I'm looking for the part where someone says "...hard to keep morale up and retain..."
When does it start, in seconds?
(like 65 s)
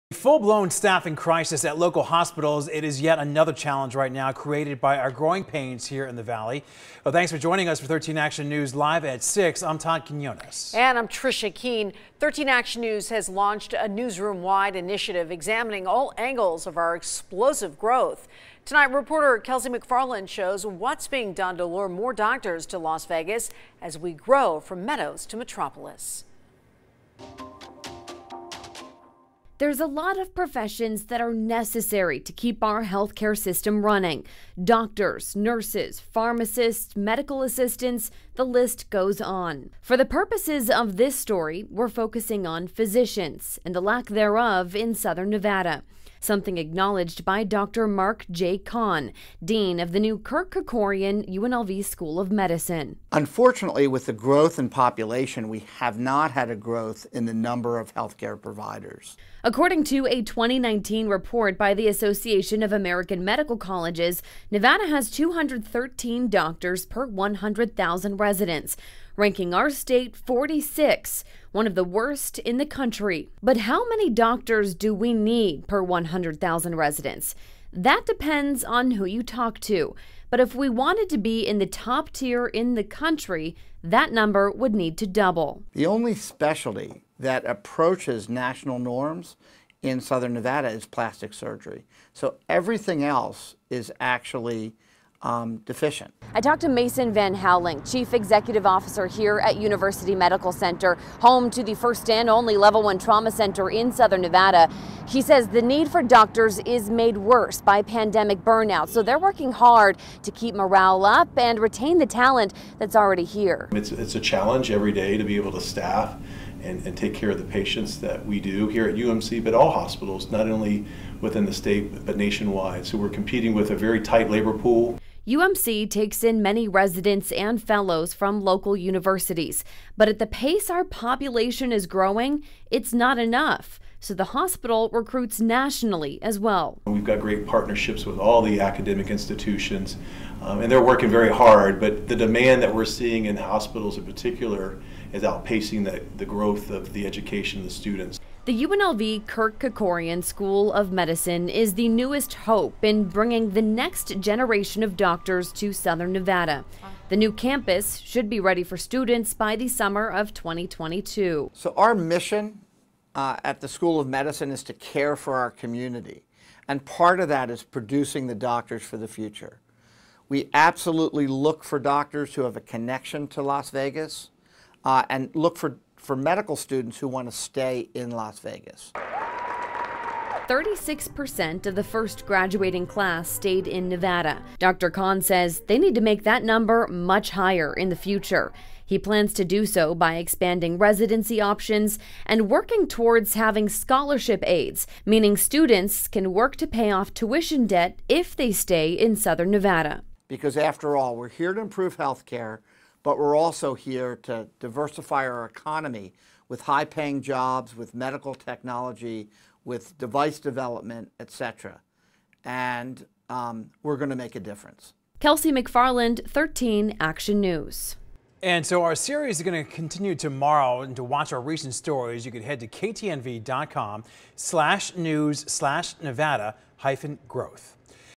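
109 s.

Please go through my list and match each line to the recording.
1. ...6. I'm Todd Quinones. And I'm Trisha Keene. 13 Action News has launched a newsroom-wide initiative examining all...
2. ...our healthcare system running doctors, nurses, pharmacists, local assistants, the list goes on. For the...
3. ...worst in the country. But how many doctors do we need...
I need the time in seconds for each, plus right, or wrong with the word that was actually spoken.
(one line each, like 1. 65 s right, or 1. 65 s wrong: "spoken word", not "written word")
1. 9 s right
2. 32 s wrong: "medical", not "local"
3. 71 s right.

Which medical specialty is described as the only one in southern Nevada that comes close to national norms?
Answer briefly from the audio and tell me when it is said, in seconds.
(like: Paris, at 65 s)
Plastic surgery, at 90 s.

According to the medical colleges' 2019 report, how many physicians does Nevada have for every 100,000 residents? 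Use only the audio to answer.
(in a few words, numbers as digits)
213.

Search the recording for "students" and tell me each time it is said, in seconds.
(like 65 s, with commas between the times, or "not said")
147 s, 158 s, 176 s, 195 s.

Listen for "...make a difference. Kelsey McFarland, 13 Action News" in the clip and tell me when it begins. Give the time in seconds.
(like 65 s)
214 s.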